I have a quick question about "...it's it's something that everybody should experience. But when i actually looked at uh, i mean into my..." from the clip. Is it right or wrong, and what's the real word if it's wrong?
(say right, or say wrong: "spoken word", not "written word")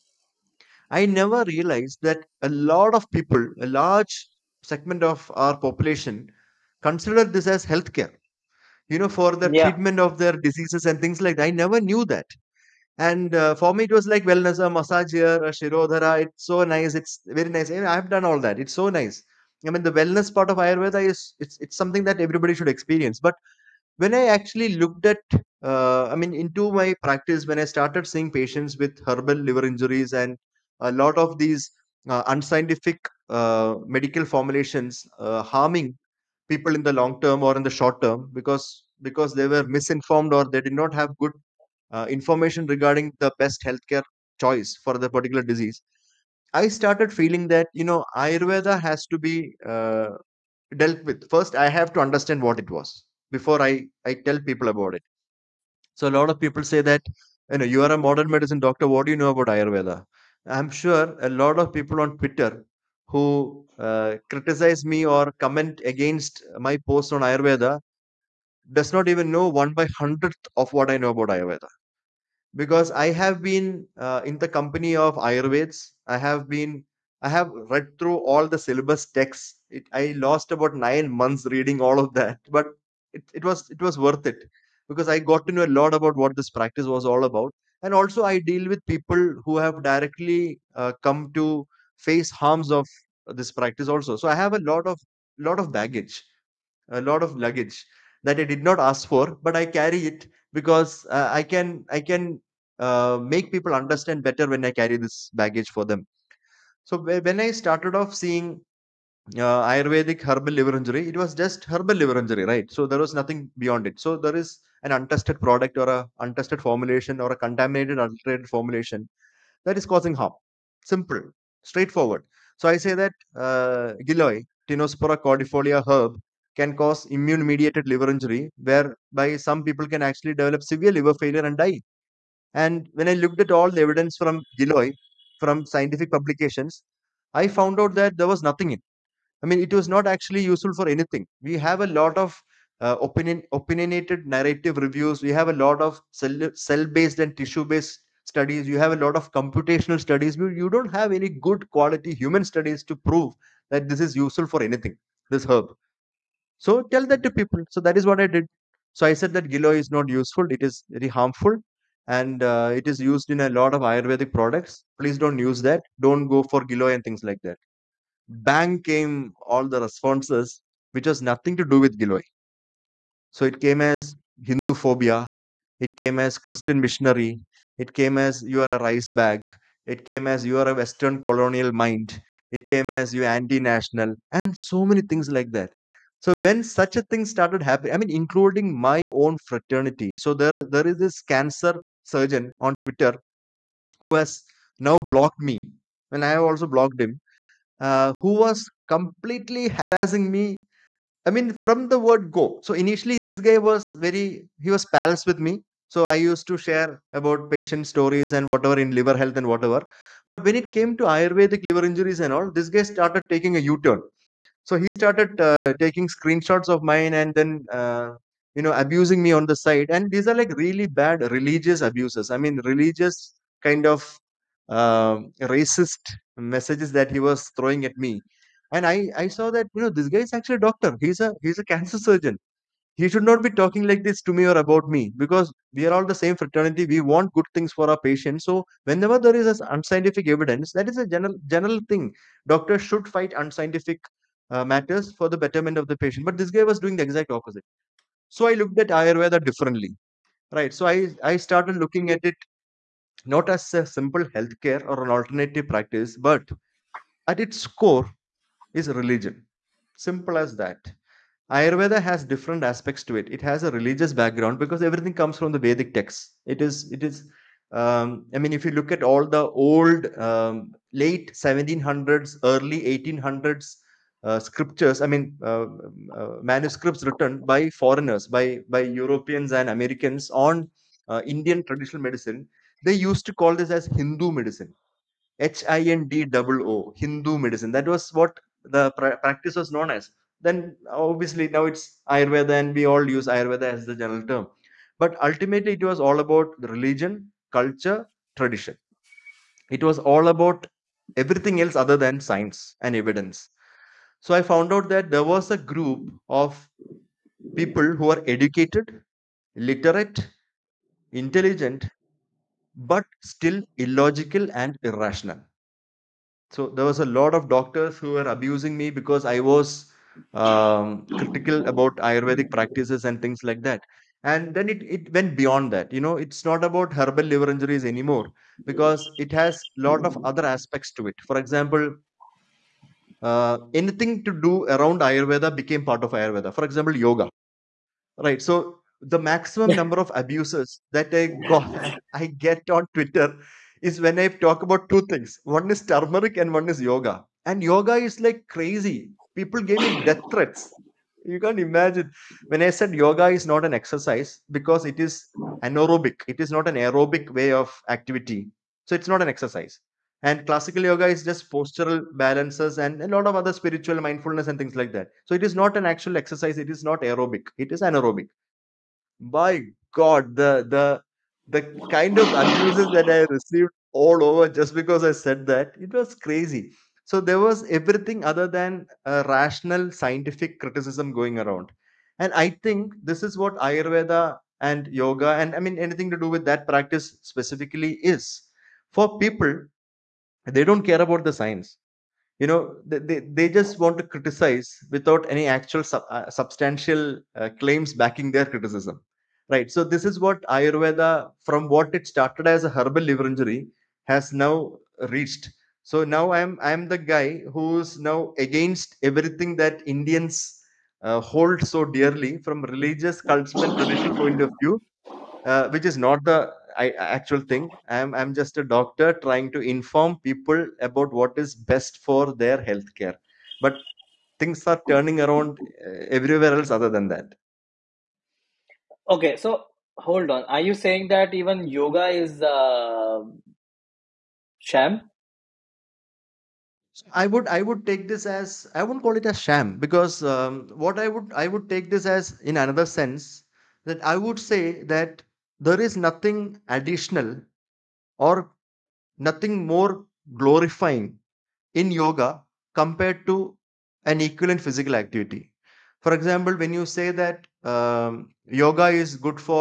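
right.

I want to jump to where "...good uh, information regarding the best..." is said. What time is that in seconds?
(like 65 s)
41 s.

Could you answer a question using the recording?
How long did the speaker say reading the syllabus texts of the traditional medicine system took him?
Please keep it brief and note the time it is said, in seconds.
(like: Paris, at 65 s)
9 months, at 80 s.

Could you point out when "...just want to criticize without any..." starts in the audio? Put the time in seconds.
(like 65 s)
393 s.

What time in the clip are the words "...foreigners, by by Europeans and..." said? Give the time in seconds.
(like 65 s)
277 s.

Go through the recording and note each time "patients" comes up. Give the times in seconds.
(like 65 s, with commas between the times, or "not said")
28 s, 207 s, 237 s, 245 s.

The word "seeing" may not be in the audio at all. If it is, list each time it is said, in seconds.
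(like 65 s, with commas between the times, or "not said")
28 s, 108 s.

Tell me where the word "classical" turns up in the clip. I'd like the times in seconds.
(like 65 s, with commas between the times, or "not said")
360 s.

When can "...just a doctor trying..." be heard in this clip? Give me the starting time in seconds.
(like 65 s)
418 s.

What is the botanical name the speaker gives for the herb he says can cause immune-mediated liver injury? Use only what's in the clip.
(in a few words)
Tinospora cordifolia.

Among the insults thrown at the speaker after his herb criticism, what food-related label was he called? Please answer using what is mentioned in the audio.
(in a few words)
rice bag.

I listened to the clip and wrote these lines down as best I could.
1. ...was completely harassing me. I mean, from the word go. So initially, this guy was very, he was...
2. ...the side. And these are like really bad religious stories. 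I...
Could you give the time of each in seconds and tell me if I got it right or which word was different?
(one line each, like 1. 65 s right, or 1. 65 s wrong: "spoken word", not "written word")
1. 198 s right
2. 219 s wrong: "abuses", not "stories".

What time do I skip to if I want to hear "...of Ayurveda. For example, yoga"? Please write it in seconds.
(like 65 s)
336 s.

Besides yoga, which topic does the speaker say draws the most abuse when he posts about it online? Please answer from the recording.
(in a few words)
turmeric.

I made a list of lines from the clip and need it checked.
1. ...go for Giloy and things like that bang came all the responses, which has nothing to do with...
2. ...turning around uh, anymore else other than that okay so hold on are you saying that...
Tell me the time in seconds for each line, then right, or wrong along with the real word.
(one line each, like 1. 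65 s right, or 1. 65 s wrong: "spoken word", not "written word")
1. 166 s right
2. 424 s wrong: "everywhere", not "anymore".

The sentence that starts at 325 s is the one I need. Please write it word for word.
You know, it's not about herbal liver injuries anymore because it has a lot of other aspects to it.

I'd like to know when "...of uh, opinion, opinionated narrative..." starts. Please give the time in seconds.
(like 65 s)
142 s.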